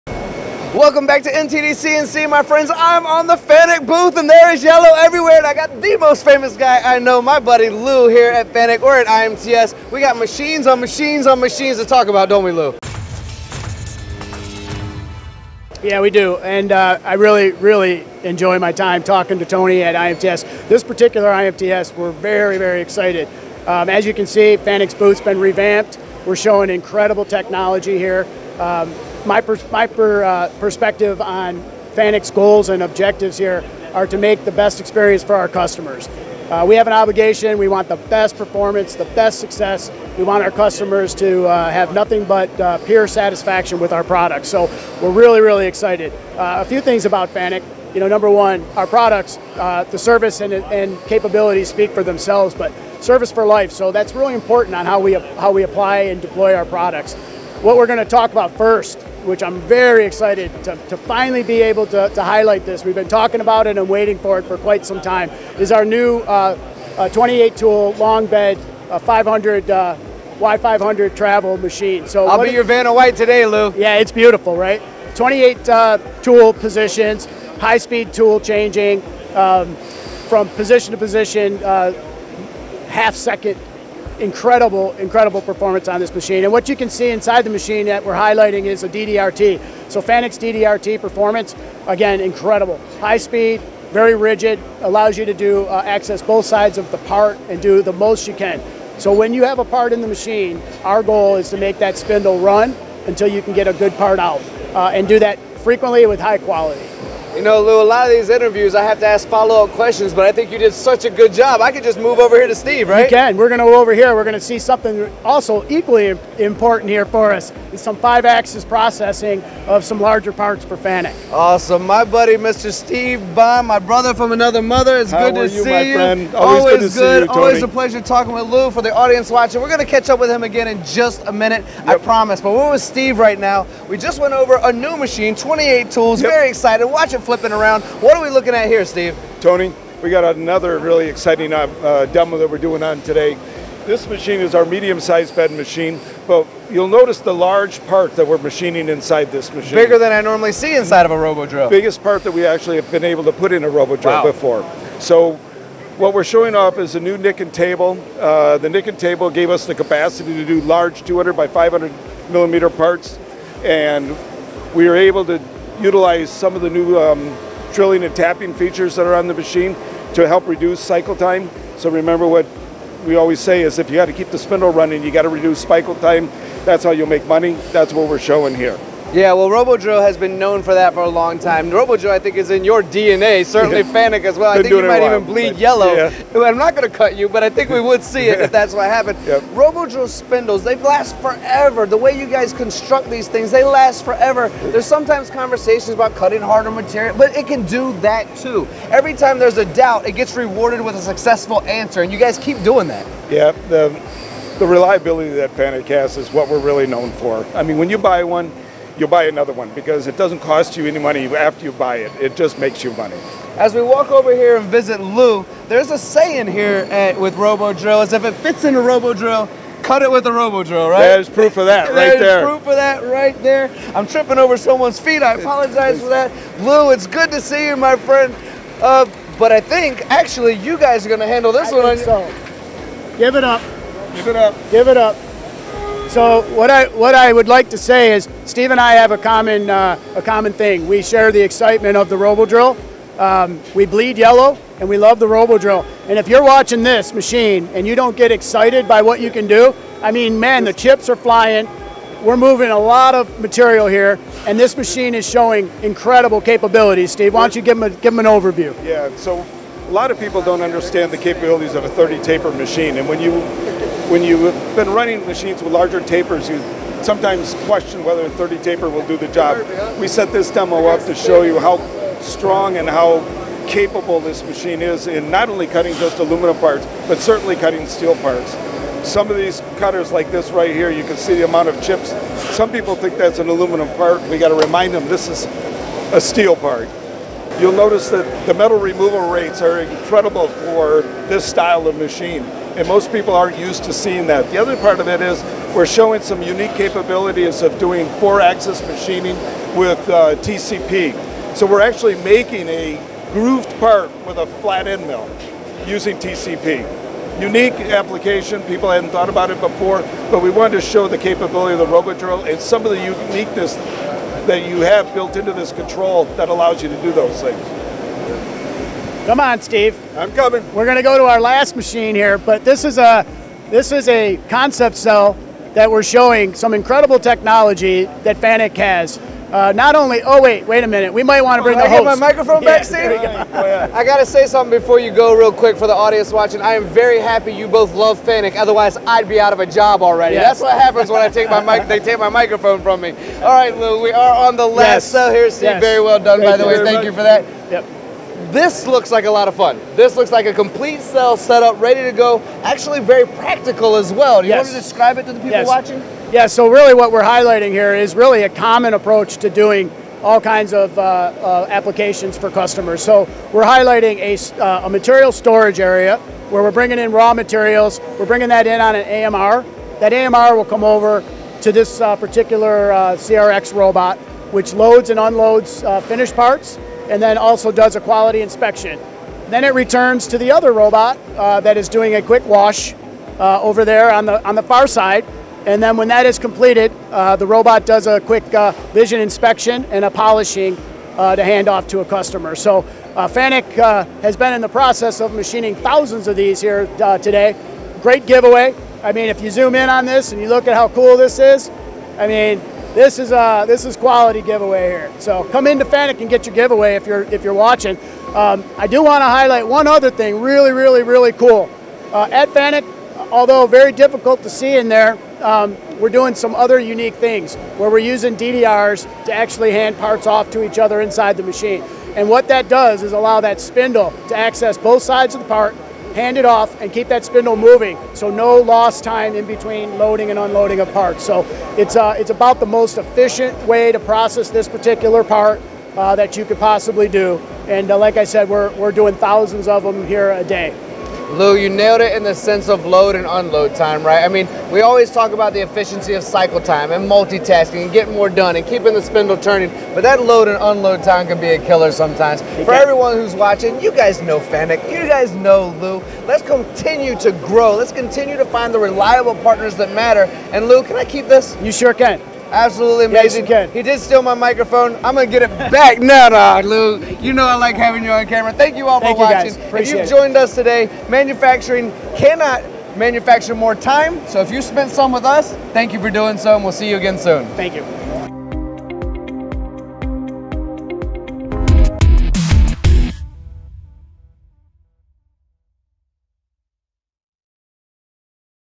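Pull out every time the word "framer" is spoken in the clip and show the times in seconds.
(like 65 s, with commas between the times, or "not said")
not said.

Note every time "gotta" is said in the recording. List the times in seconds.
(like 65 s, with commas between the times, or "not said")
284 s, 334 s.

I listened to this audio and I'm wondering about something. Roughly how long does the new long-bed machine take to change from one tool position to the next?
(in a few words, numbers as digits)
half second.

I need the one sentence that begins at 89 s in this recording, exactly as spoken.
So Fanuc's DDRT performance, again, incredible.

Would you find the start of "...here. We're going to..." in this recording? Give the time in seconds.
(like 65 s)
113 s.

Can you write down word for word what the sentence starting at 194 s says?
There's sometimes conversations about cutting harder material, but it can do that too.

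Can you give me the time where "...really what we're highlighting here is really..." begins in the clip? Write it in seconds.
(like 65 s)
356 s.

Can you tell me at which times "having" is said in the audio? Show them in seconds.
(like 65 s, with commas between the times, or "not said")
467 s.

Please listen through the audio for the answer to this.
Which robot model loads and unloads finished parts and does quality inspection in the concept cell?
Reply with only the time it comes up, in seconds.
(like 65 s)
373 s.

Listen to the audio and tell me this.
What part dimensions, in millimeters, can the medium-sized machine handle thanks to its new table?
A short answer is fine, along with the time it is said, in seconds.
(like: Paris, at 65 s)
200 by 500, at 161 s.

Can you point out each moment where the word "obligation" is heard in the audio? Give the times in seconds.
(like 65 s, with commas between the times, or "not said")
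36 s.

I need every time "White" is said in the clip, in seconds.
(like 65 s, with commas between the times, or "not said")
72 s.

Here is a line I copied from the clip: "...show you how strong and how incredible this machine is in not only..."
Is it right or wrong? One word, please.
wrong.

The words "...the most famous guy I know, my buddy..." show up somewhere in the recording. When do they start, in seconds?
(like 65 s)
5 s.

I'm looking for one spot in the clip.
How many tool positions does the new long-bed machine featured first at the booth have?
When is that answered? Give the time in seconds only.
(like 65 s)
67 s.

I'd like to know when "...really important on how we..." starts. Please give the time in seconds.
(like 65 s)
54 s.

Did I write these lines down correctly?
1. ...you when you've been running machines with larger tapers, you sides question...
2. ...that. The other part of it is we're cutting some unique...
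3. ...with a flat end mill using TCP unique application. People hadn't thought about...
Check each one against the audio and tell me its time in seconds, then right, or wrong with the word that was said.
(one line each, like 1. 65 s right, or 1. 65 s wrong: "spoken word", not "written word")
1. 263 s wrong: "sometimes", not "sides"
2. 294 s wrong: "showing", not "cutting"
3. 304 s right.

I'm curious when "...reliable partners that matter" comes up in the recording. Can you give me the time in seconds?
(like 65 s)
458 s.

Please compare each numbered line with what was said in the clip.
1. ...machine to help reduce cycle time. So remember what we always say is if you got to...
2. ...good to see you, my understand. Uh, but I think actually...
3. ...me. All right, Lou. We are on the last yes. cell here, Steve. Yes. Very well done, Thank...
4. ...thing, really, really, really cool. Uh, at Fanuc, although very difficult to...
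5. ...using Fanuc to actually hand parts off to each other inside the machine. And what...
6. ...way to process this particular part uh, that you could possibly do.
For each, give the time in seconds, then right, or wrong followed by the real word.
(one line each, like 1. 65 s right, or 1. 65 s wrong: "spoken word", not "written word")
1. 169 s right
2. 227 s wrong: "friend", not "understand"
3. 343 s right
4. 410 s right
5. 417 s wrong: "DDRs", not "Fanuc"
6. 433 s right.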